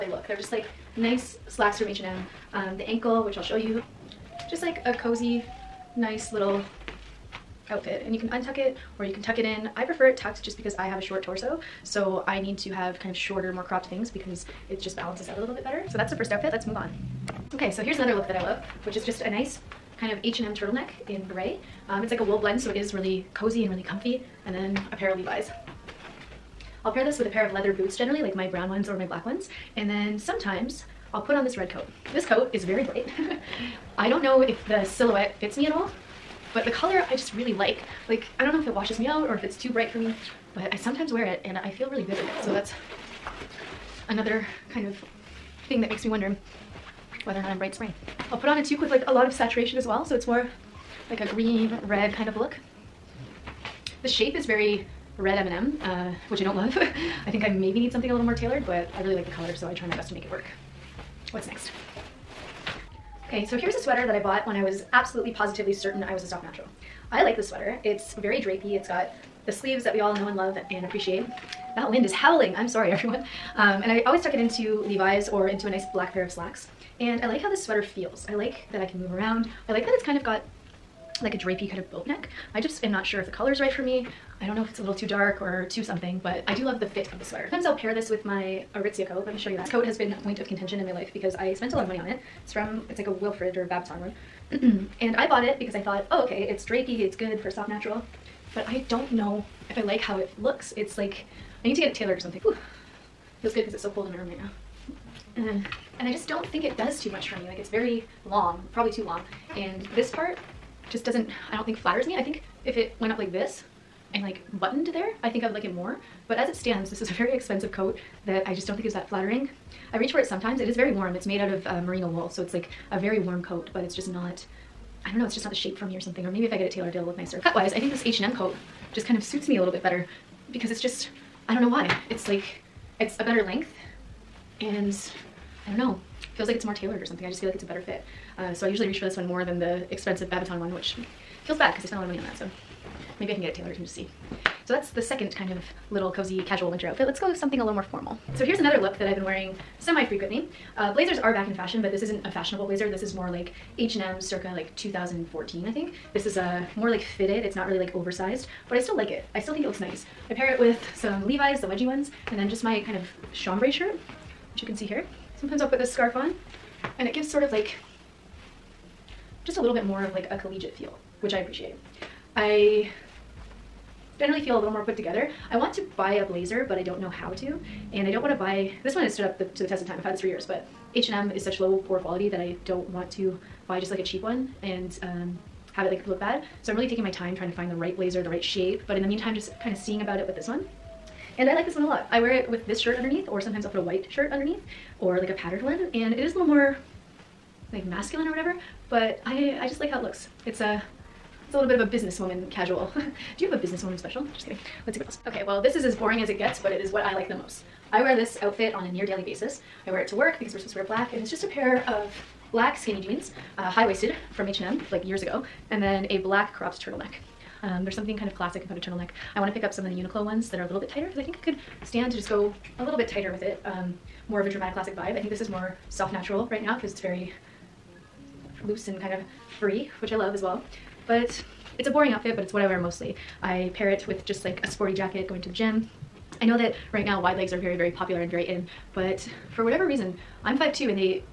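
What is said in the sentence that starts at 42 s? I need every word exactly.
So that's another kind of thing that makes me wonder whether or not I'm bright spring.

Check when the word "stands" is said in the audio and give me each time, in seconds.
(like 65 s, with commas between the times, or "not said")
116 s, 221 s.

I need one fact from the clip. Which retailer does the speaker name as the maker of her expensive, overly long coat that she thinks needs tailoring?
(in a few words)
Aritzia.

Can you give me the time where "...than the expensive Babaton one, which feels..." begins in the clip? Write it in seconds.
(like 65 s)
139 s.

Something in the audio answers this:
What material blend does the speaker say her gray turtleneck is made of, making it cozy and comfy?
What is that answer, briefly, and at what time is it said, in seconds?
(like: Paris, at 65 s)
wool blend, at 22 s.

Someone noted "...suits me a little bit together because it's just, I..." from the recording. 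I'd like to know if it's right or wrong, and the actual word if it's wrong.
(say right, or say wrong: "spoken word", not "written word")
wrong: "better", not "together".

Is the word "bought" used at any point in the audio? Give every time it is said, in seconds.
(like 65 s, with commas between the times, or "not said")
64 s, 95 s.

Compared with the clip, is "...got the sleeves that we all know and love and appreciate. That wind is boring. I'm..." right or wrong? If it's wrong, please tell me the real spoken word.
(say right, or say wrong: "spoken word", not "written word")
wrong: "howling", not "boring".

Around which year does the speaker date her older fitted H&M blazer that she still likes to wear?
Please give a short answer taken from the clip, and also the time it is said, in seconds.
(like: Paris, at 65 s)
2014, at 154 s.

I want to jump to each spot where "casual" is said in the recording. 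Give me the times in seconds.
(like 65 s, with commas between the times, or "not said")
146 s, 202 s.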